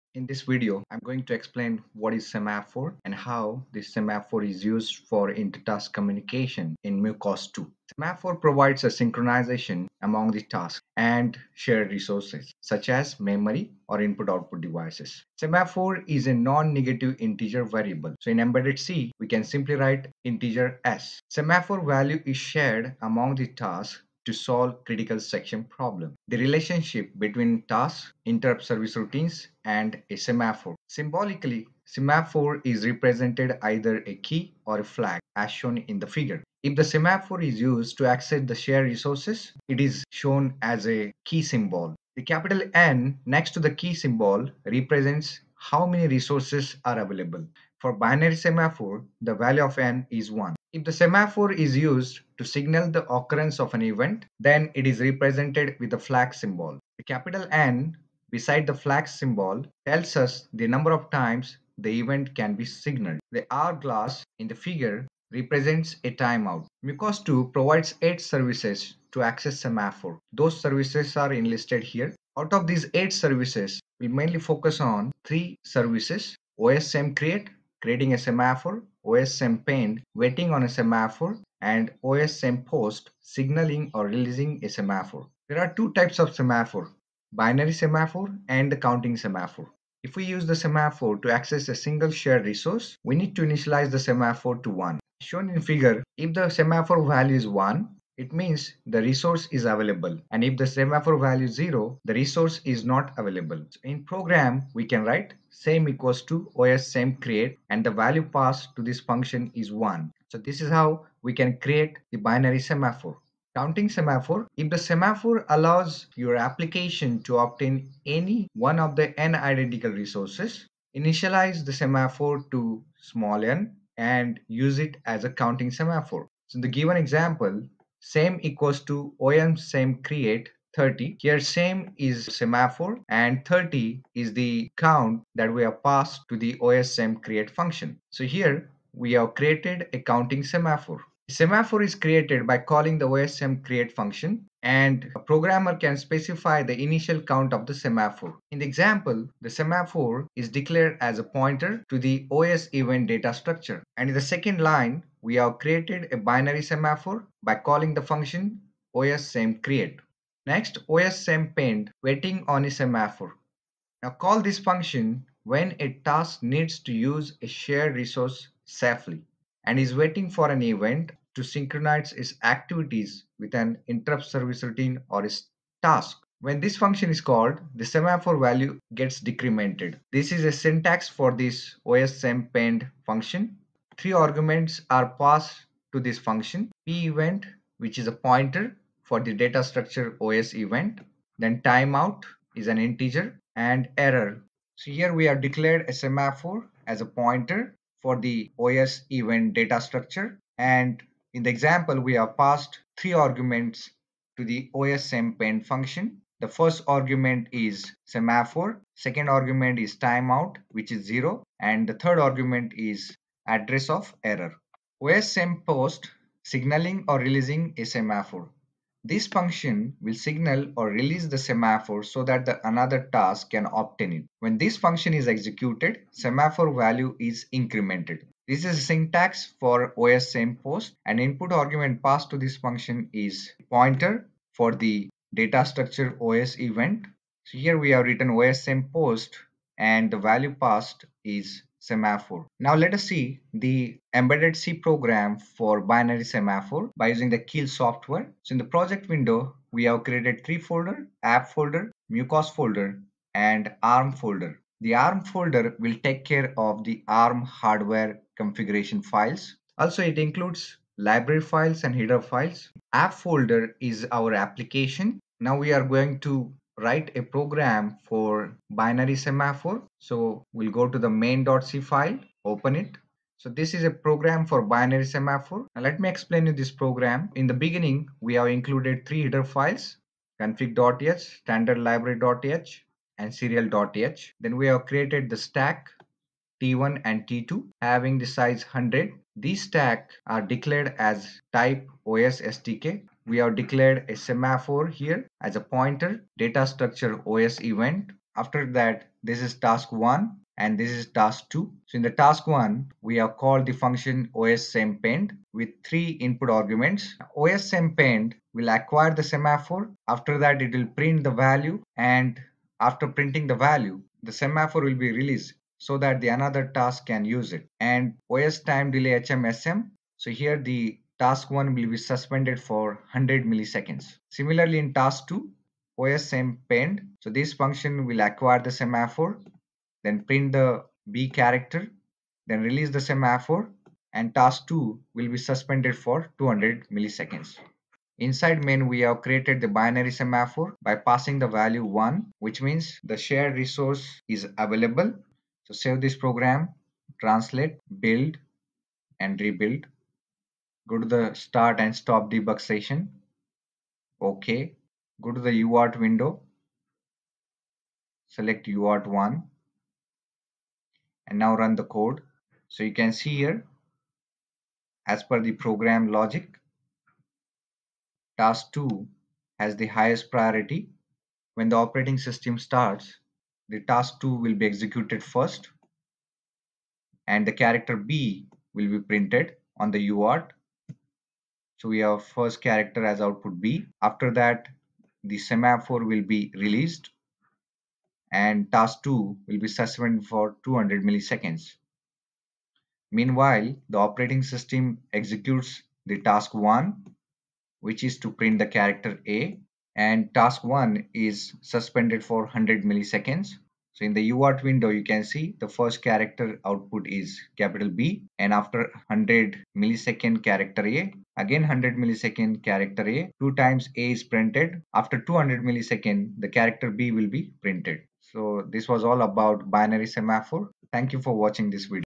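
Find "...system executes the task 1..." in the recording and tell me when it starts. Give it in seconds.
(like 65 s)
394 s.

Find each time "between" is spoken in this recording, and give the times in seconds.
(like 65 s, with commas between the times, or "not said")
27 s.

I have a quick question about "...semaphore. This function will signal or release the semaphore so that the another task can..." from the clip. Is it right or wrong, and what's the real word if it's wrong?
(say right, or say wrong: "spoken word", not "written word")
right.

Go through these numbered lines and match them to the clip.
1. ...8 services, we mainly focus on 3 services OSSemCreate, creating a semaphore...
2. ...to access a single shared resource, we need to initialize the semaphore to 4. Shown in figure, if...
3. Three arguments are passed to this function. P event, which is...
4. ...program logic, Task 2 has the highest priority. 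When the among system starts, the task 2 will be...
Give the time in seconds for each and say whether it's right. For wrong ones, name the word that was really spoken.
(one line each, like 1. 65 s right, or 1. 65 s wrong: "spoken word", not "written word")
1. 72 s right
2. 91 s wrong: "1", not "4"
3. 183 s right
4. 365 s wrong: "operating", not "among".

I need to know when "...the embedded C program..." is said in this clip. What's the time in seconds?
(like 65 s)
243 s.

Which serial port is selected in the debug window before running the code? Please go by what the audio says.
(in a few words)
UART1.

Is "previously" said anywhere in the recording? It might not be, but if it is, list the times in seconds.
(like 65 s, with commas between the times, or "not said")
not said.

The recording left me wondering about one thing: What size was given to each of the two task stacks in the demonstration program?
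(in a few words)
100.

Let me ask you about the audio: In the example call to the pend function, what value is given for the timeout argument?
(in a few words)
0.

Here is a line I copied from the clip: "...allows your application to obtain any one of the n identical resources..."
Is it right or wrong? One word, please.
right.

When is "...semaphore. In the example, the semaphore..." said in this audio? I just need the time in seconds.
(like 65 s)
147 s.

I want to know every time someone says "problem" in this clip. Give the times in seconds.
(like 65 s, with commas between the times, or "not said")
25 s.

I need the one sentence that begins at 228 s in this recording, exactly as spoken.
This is syntax for OSSemPost and input argument passed to this function is pointer for the data structure OS event.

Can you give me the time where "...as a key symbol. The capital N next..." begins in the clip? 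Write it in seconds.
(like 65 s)
40 s.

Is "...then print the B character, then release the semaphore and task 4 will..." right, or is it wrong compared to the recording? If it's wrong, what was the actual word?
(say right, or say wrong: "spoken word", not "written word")
wrong: "2", not "4".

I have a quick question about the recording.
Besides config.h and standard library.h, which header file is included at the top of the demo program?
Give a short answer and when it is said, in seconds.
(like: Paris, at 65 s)
serial.h, at 283 s.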